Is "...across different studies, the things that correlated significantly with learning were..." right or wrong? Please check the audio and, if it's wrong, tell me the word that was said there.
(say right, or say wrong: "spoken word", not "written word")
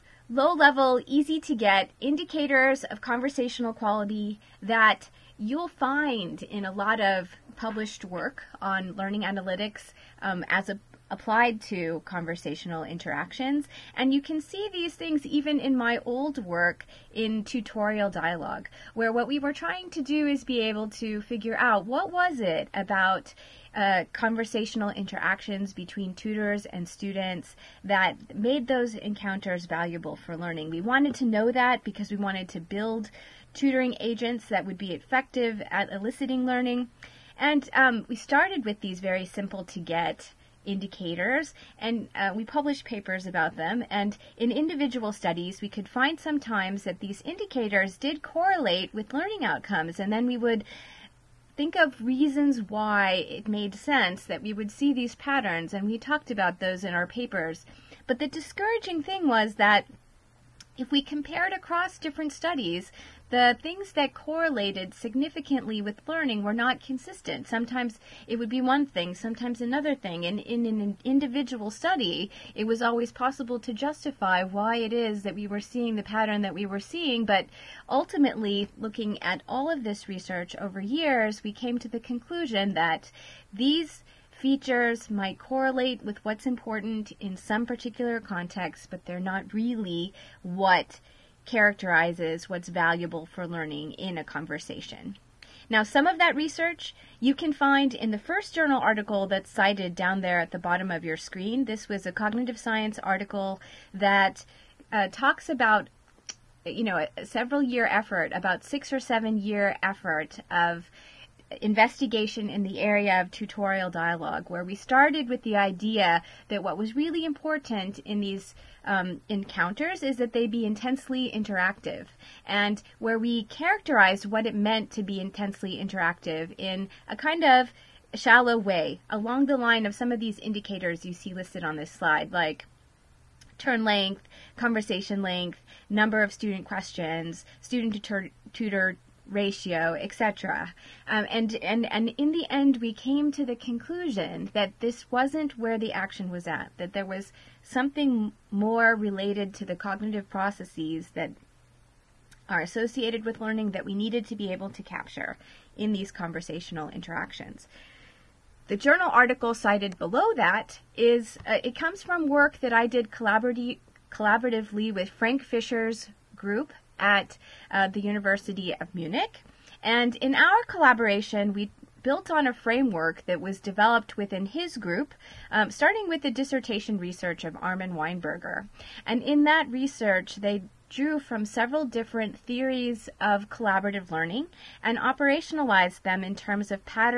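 right.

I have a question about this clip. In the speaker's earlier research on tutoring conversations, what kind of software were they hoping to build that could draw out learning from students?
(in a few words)
tutoring agents.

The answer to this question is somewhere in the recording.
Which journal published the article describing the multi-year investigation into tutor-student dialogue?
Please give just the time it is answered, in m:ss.
1:42.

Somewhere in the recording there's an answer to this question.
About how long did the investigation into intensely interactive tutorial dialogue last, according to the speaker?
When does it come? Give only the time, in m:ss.
1:48.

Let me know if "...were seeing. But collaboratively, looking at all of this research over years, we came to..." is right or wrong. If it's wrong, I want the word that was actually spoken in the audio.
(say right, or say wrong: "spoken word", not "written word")
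wrong: "ultimately", not "collaboratively".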